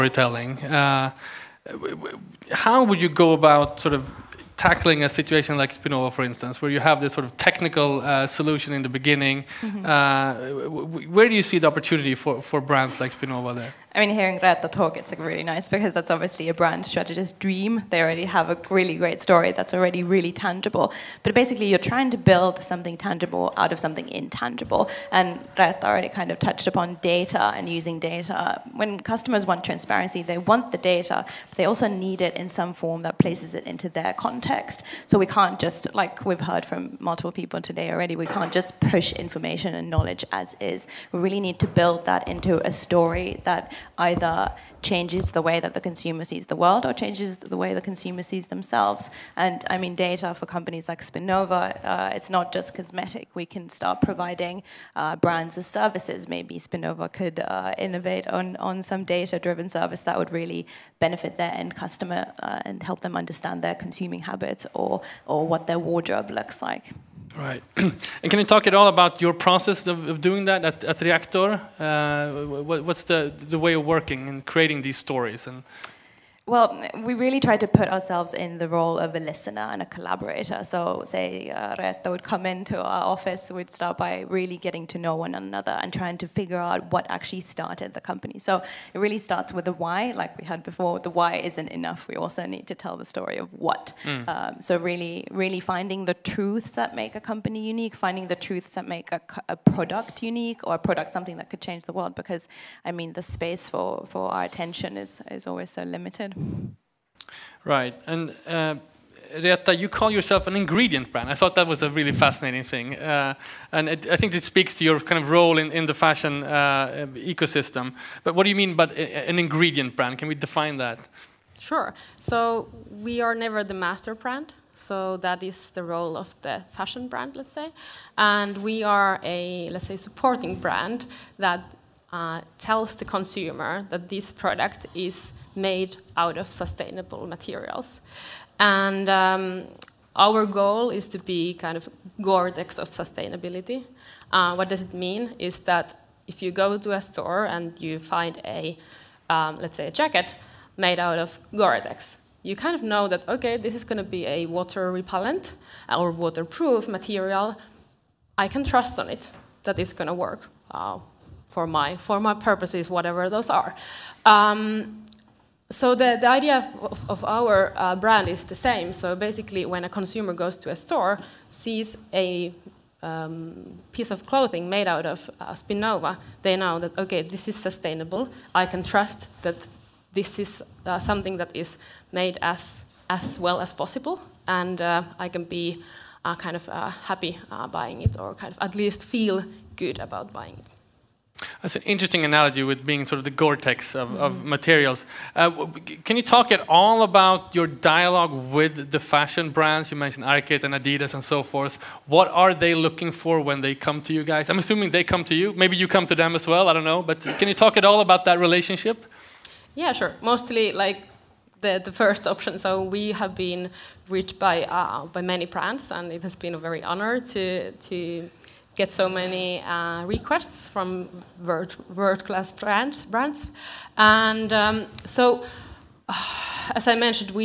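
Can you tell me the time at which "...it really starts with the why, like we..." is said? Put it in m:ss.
1:28.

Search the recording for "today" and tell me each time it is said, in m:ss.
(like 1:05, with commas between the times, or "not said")
0:37.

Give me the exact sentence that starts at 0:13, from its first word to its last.
I mean, hearing Reetta talk, it's really nice because that's obviously a brand strategist's dream.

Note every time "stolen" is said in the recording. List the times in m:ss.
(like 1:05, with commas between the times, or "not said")
not said.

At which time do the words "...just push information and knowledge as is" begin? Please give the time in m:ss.
0:38.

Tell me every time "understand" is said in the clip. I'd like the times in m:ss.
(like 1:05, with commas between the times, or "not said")
1:03.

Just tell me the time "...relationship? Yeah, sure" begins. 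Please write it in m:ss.
3:28.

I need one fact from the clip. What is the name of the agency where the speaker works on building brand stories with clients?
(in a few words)
Reactor.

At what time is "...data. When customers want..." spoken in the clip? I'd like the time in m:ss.
0:27.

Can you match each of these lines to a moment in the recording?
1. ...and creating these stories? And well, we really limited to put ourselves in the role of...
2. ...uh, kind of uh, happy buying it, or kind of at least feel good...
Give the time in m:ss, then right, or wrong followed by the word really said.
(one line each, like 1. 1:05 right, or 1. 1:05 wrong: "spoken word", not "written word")
1. 1:14 wrong: "tried", not "limited"
2. 3:06 right.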